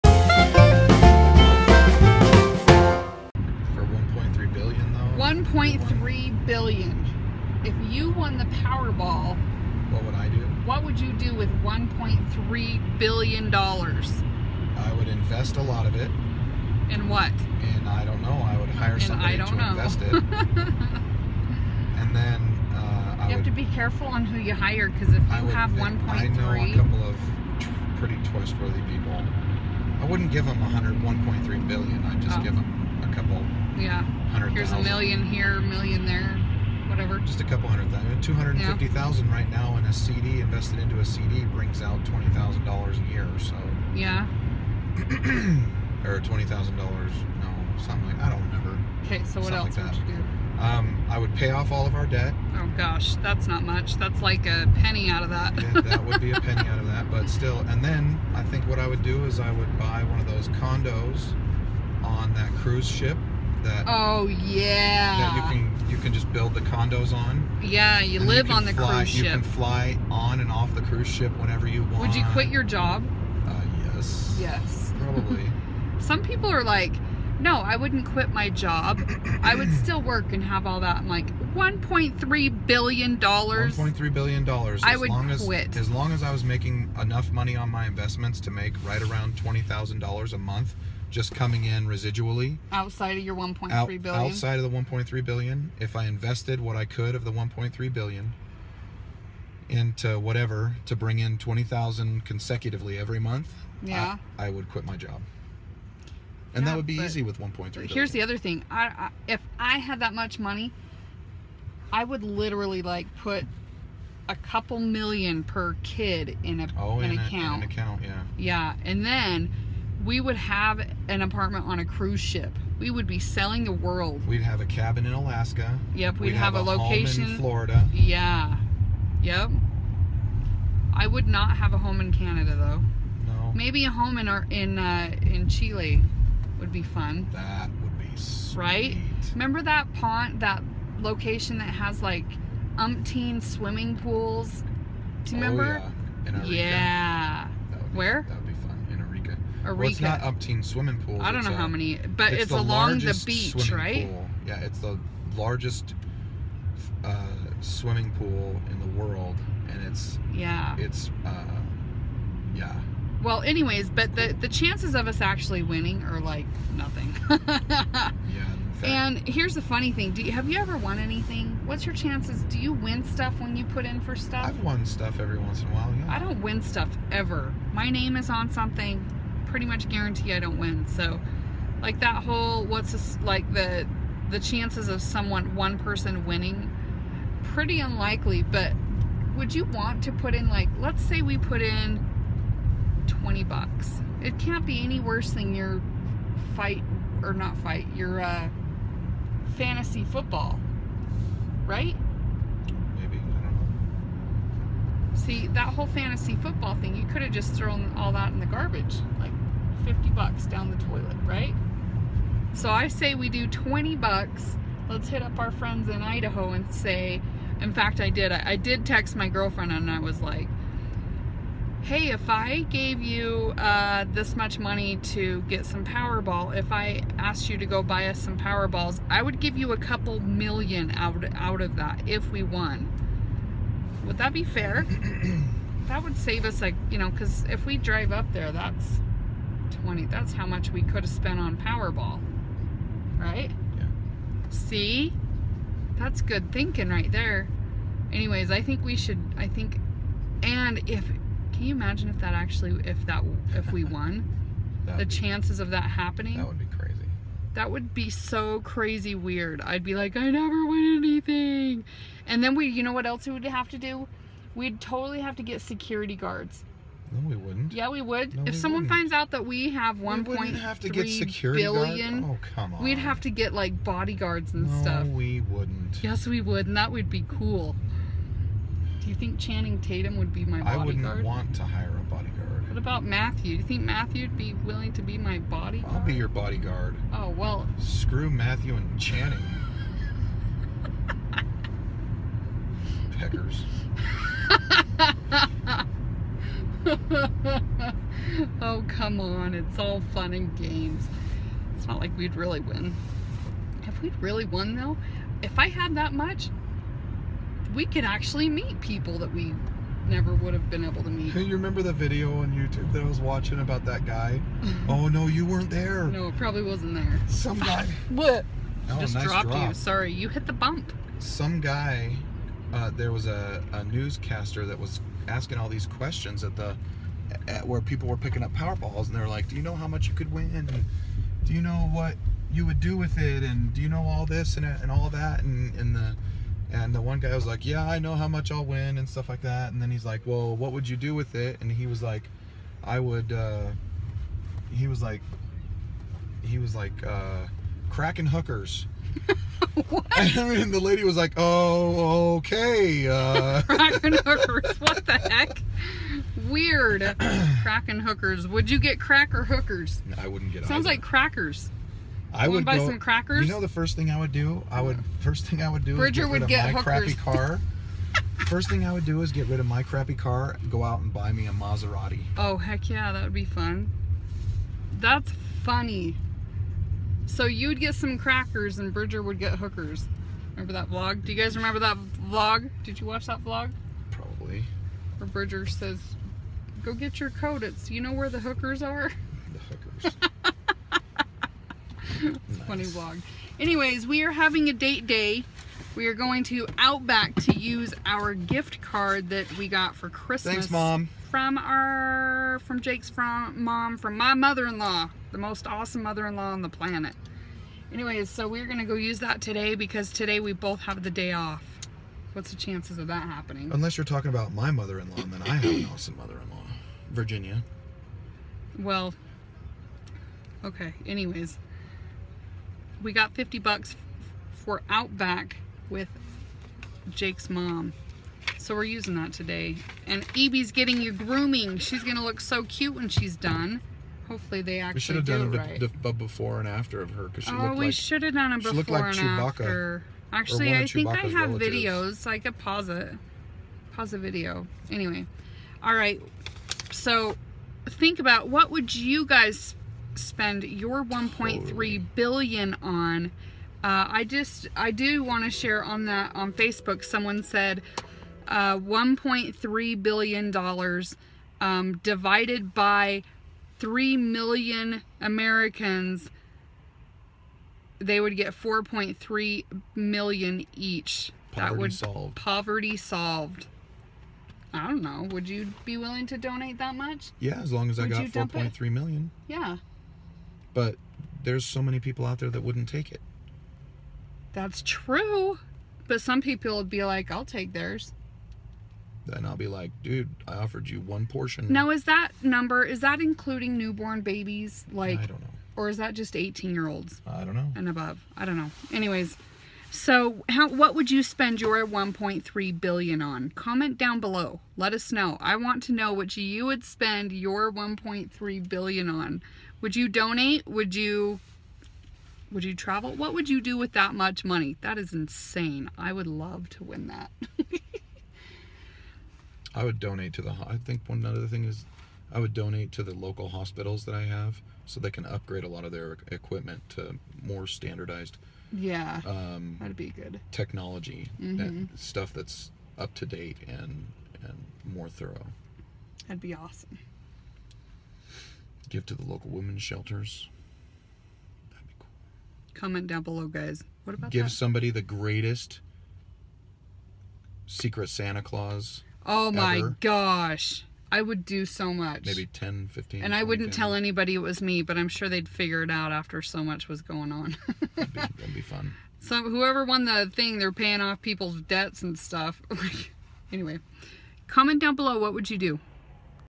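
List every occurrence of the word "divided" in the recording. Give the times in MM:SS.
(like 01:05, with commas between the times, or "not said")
07:42.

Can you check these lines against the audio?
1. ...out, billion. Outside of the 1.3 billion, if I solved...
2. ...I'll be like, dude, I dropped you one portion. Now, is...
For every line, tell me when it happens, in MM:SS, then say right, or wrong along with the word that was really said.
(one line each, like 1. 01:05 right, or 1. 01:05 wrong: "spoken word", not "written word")
1. 01:33 wrong: "invested", not "solved"
2. 08:09 wrong: "offered", not "dropped".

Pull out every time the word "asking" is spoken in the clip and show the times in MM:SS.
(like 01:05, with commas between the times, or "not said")
05:25.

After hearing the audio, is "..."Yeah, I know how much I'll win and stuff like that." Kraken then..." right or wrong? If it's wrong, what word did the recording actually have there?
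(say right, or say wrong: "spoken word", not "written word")
wrong: "And", not "Kraken".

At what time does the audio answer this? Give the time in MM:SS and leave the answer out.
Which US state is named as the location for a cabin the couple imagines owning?
02:05.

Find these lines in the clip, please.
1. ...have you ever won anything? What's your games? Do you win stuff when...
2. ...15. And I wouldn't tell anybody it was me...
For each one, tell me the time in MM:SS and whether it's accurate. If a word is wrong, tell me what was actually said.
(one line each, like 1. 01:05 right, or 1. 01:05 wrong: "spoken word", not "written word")
1. 02:50 wrong: "chances", not "games"
2. 09:12 right.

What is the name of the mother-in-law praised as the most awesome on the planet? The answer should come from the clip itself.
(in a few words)
Virginia.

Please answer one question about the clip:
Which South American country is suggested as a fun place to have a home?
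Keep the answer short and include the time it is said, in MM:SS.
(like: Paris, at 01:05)
Chile, at 02:15.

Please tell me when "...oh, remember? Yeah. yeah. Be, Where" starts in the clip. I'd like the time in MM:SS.
02:25.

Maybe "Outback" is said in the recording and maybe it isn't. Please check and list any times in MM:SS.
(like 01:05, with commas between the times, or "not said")
06:36, 07:04.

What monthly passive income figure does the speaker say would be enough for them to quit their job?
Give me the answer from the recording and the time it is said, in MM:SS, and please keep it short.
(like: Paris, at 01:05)
$20,000, at 01:29.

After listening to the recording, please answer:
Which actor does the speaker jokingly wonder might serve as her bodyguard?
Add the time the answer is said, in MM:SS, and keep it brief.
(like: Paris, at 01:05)
Channing Tatum, at 04:39.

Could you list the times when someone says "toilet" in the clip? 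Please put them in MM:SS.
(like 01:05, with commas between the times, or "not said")
03:30.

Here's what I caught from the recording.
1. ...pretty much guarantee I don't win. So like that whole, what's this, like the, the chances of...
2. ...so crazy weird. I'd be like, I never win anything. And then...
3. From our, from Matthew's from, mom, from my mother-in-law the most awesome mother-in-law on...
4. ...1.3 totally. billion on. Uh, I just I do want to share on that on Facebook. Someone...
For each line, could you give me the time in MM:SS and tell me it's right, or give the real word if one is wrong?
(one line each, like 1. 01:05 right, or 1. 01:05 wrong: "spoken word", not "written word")
1. 02:59 right
2. 04:18 right
3. 06:41 wrong: "Jake", not "Matthew"
4. 07:31 right.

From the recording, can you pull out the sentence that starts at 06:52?
What's the chances of that happening?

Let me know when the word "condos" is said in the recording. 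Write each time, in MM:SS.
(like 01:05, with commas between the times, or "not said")
01:00, 01:06.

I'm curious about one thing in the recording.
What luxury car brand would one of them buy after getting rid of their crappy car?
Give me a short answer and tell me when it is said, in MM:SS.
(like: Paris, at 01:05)
Maserati, at 06:11.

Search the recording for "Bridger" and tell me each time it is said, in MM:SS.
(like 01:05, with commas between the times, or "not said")
06:05, 06:18, 06:25.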